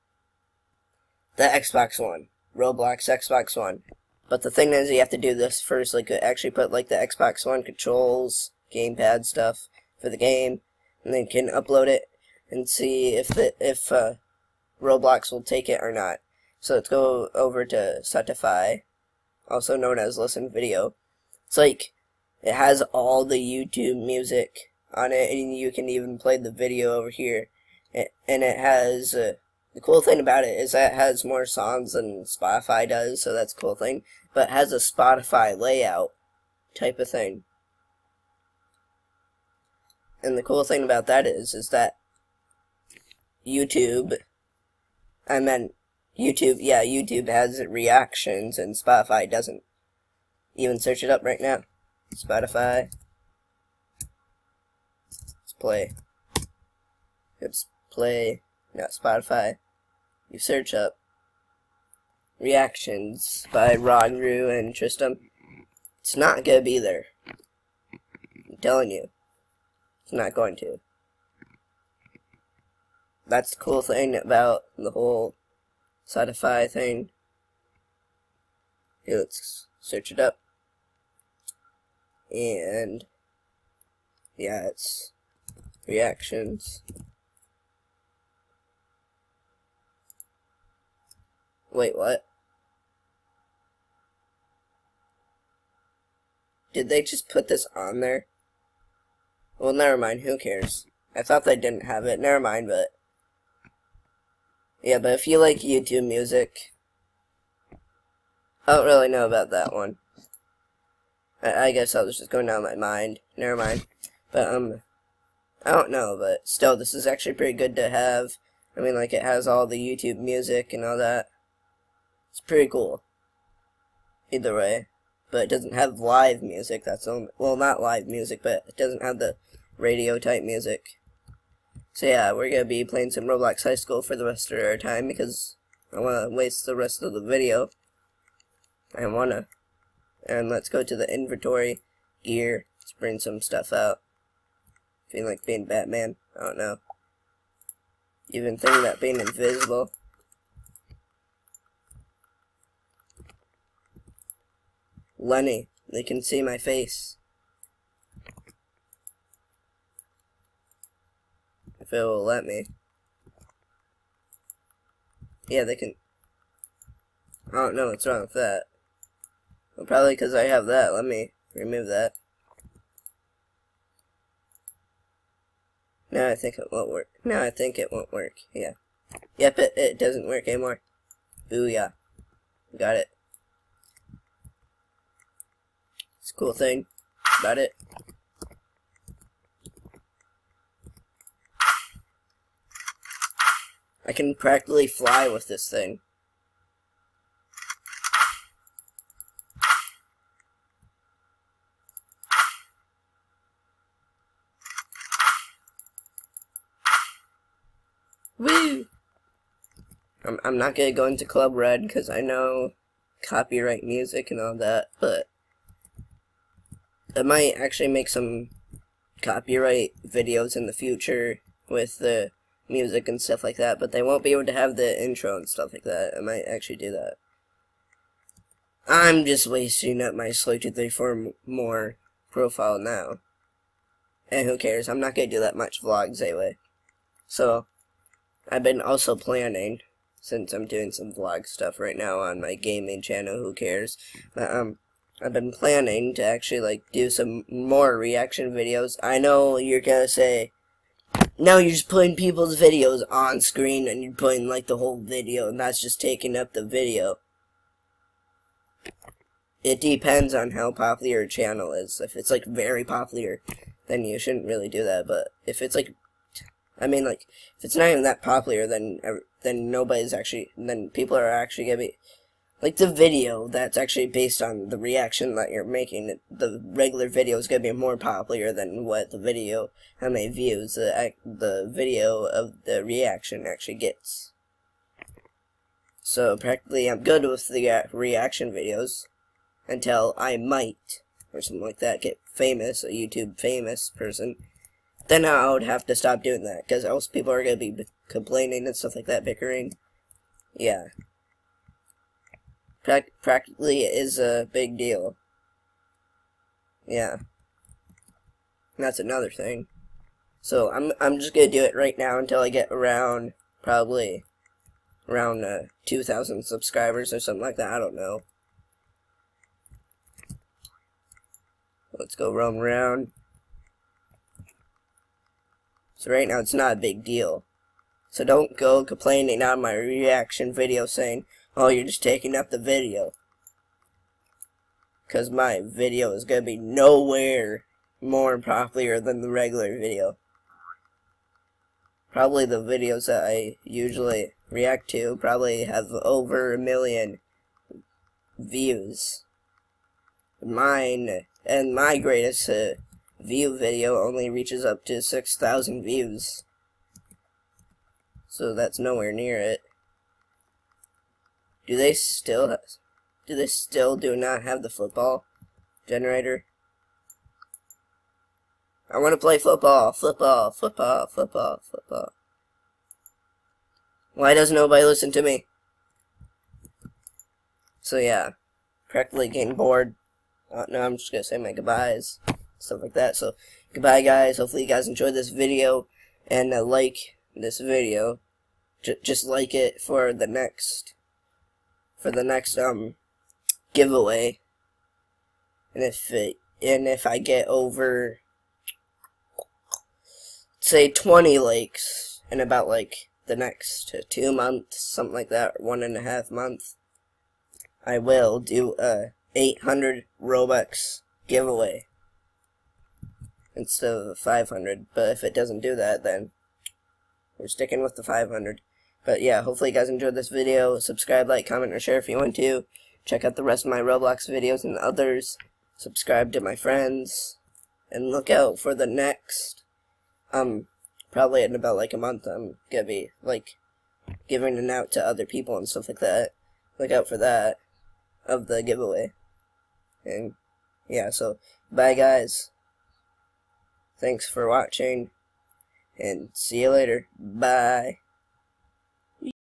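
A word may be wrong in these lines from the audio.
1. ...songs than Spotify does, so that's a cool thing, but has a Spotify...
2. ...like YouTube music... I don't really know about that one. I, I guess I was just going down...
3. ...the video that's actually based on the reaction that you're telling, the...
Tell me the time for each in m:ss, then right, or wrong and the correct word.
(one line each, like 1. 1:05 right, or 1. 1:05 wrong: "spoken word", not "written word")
1. 0:31 right
2. 1:45 right
3. 4:32 wrong: "making", not "telling".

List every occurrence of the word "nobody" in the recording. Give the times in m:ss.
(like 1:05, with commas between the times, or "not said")
4:29, 6:14.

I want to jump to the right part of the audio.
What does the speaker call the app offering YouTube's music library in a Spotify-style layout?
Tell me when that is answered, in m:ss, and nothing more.
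0:18.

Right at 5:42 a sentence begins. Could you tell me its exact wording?
Probably the videos that I usually react to probably have over a million views.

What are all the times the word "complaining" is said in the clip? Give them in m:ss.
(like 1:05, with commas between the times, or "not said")
4:58, 5:28.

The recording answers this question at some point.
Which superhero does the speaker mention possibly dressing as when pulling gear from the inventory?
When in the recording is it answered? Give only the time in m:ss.
2:25.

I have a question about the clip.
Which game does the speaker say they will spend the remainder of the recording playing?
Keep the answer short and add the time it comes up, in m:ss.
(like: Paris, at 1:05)
Roblox High School, at 2:13.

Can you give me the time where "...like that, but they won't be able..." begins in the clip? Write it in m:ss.
3:43.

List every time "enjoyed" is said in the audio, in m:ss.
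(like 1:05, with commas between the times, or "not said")
6:24, 6:59.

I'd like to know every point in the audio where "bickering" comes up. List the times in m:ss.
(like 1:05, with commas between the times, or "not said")
4:59.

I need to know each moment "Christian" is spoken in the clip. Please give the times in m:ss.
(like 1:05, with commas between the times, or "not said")
not said.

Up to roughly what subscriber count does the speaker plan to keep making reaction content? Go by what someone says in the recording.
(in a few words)
2,000.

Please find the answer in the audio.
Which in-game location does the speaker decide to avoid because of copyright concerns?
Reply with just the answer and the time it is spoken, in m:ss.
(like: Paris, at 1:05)
Club Red, at 3:31.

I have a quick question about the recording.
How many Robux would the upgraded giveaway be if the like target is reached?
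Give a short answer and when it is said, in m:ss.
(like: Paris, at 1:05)
800, at 6:49.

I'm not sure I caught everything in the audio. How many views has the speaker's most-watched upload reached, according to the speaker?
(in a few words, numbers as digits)
6,000.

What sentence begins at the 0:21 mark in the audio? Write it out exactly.
It's like, it has all the YouTube music on it, and you can even play the video over here.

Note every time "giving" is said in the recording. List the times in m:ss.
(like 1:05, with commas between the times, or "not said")
7:14.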